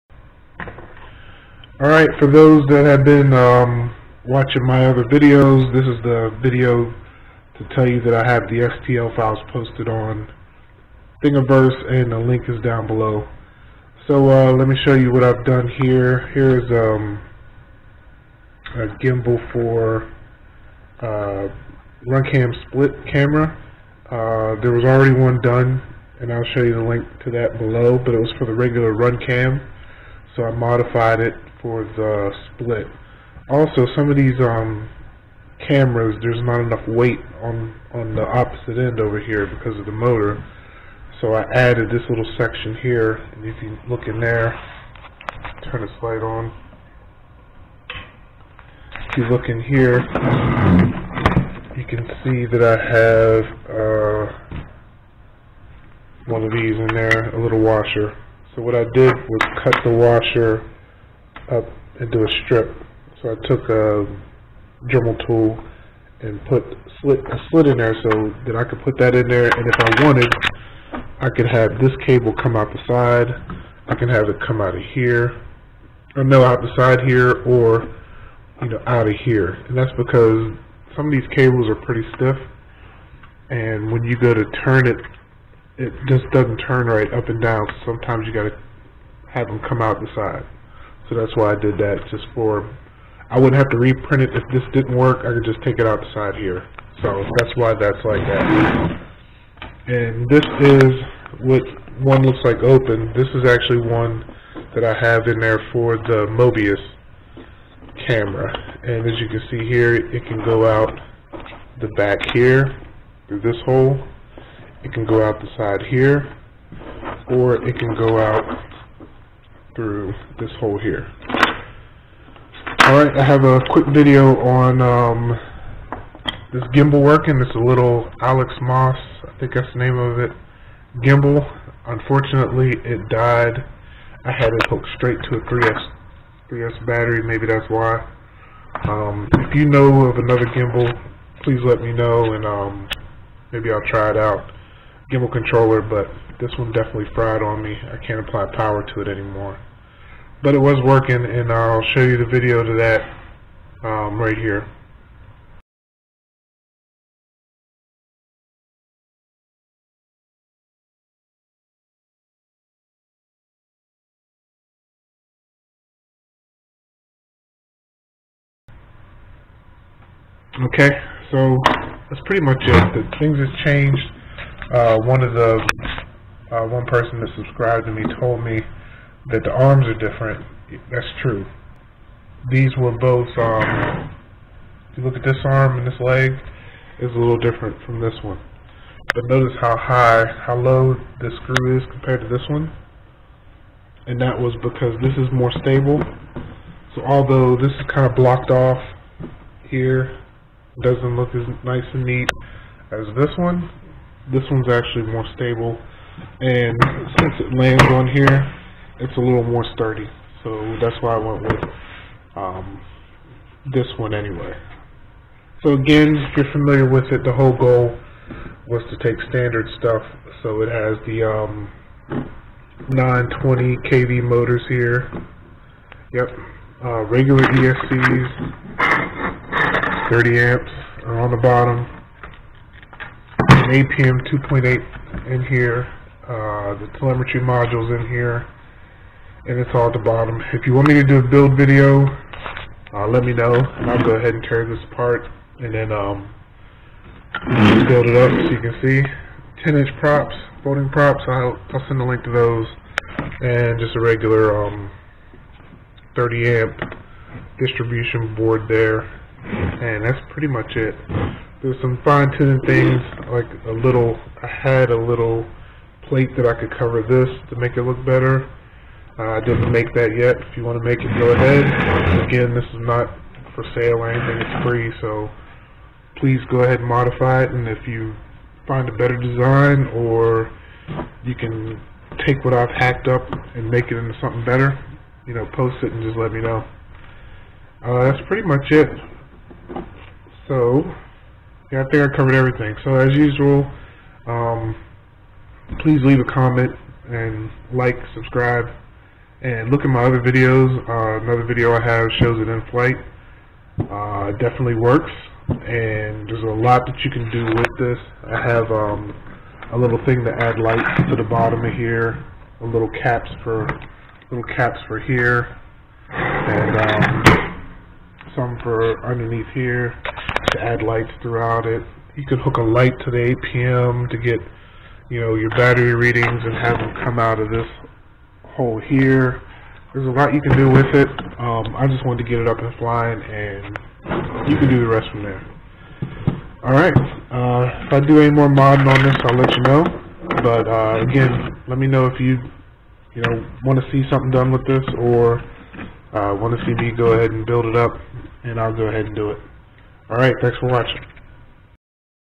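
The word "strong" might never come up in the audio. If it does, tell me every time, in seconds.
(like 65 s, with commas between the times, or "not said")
not said.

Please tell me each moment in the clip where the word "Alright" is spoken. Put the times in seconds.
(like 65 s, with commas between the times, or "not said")
1 s, 122 s, 336 s.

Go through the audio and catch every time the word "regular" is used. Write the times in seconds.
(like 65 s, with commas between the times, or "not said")
28 s, 227 s, 254 s.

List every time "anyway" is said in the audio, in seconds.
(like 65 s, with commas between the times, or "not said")
214 s.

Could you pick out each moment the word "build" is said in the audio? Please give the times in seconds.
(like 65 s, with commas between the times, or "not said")
241 s, 247 s, 347 s.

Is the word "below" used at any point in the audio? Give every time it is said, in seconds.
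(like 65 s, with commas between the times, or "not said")
12 s, 27 s.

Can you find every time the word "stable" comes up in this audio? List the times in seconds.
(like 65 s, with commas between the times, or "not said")
195 s, 205 s.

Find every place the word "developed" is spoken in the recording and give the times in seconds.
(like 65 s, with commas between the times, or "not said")
not said.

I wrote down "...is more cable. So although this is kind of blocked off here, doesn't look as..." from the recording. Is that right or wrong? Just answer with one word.
wrong.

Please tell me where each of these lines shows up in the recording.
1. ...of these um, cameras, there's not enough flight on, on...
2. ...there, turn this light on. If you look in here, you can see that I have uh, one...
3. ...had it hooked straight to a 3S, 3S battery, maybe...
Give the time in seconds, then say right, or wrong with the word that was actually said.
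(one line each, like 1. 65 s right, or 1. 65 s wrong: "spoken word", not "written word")
1. 34 s wrong: "weight", not "flight"
2. 44 s right
3. 134 s right.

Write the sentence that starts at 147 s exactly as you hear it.
I can't apply power to it anymore.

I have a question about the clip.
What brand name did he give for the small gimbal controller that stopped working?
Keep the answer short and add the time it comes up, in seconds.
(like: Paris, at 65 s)
AlexMos, at 128 s.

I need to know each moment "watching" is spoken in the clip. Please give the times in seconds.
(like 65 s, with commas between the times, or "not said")
4 s, 350 s.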